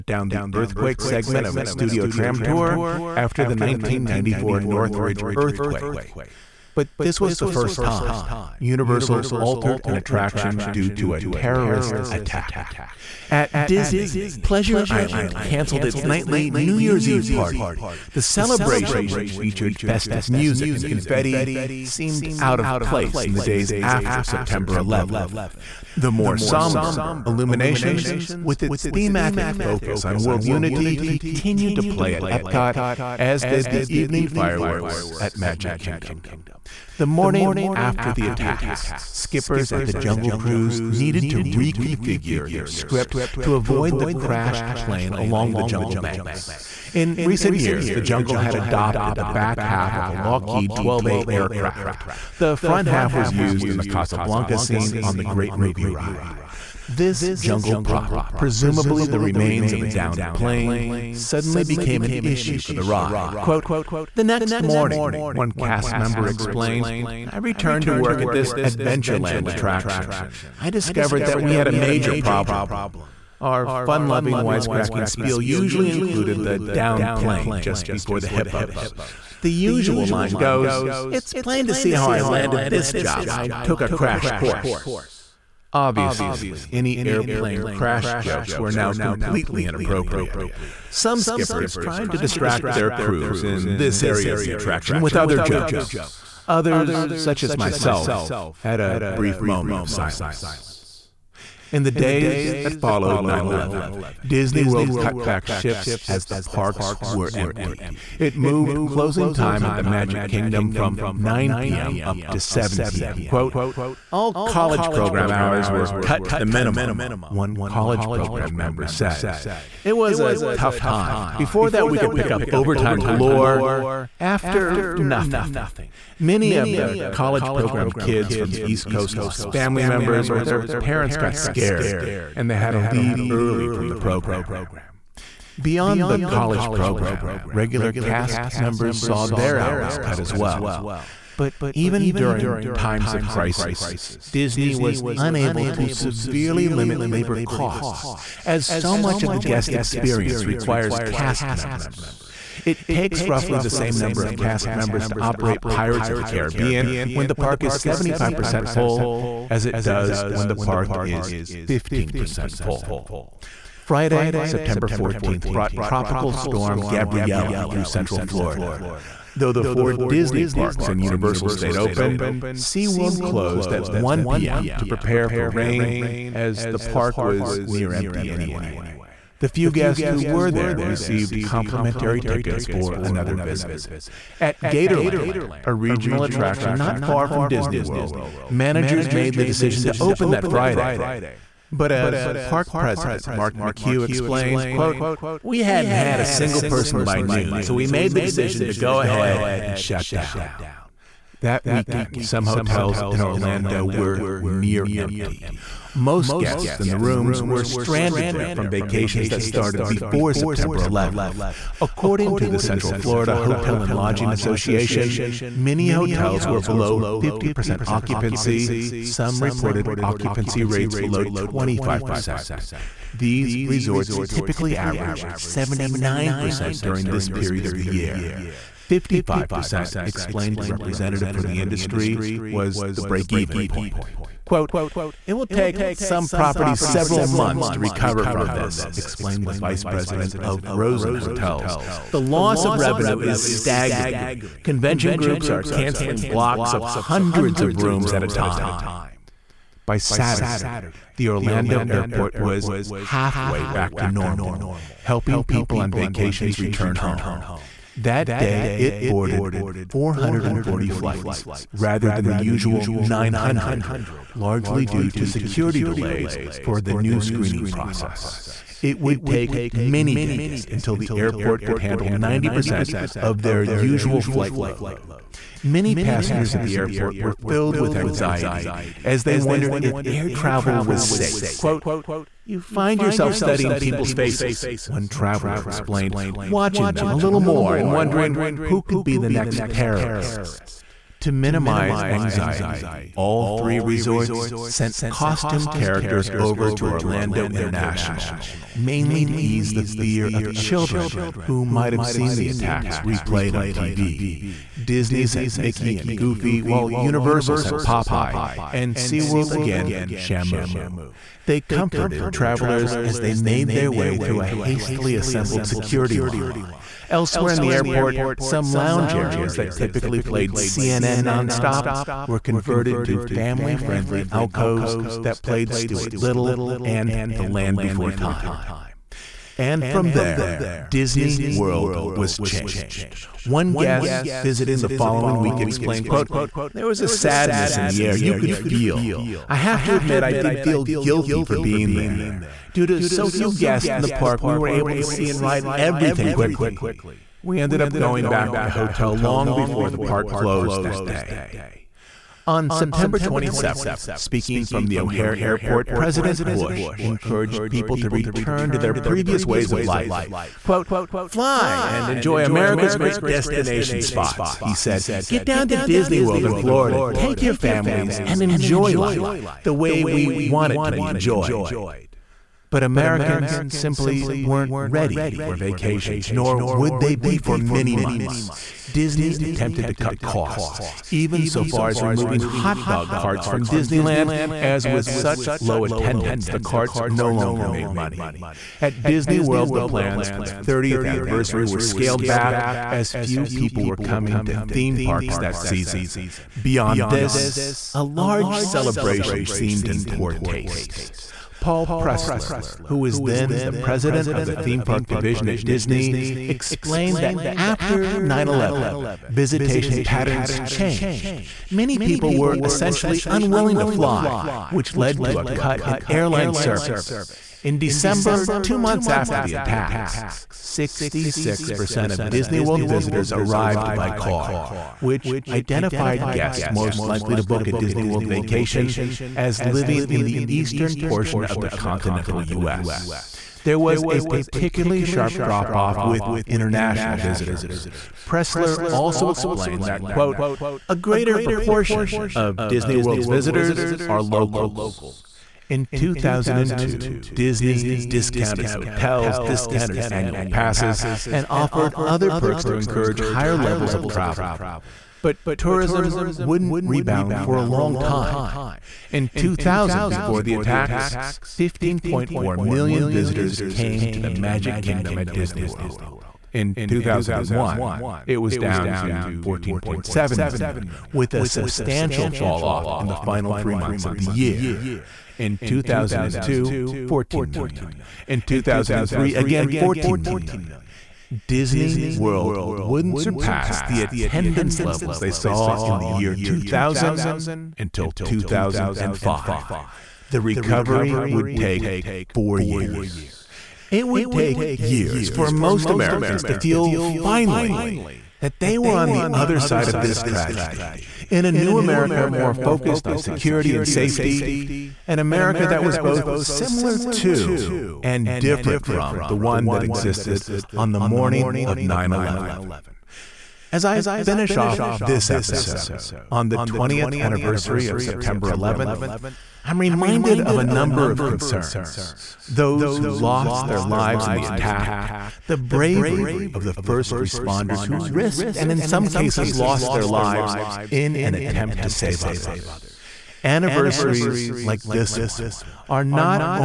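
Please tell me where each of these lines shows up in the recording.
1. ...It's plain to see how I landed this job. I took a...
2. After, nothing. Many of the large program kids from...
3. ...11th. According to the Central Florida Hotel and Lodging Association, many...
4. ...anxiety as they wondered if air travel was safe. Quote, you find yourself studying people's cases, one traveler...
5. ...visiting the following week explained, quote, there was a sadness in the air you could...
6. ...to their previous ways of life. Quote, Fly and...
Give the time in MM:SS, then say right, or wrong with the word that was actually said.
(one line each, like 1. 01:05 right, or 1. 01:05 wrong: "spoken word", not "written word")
1. 01:21 right
2. 02:04 wrong: "college", not "large"
3. 03:30 right
4. 04:37 wrong: "faces", not "cases"
5. 05:34 right
6. 05:58 right.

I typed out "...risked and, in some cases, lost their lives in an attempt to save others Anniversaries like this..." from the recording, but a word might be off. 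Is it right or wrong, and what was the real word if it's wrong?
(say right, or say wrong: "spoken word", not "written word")
right.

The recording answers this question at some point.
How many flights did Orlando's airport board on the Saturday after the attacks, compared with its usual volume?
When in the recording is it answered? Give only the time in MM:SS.
04:19.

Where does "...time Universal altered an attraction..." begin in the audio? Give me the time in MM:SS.
00:07.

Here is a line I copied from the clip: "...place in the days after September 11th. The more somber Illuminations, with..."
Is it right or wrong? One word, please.
right.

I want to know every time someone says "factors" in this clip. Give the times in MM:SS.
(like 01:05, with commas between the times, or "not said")
not said.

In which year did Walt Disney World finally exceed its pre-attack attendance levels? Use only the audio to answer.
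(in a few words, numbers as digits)
2005.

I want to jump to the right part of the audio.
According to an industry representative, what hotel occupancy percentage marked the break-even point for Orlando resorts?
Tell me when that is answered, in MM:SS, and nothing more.
03:48.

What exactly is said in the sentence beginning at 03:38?
Some reported occupancy rates below 25%.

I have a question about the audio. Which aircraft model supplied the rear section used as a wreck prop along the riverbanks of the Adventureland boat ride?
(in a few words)
Lockheed 12A.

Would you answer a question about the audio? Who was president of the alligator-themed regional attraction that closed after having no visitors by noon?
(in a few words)
Mark McHugh.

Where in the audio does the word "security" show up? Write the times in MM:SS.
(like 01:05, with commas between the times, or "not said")
04:25, 05:15, 08:23.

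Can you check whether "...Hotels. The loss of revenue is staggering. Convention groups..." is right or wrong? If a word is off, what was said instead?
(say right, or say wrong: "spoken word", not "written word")
right.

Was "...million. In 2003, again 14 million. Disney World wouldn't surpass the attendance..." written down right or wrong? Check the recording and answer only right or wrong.
right.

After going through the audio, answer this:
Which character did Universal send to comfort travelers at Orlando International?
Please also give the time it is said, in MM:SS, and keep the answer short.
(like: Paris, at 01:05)
Popeye, at 05:07.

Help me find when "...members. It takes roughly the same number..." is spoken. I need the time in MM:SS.
02:31.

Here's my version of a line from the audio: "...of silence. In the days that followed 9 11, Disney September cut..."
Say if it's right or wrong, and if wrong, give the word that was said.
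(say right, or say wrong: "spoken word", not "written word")
wrong: "World", not "September".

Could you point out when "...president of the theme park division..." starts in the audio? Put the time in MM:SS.
06:43.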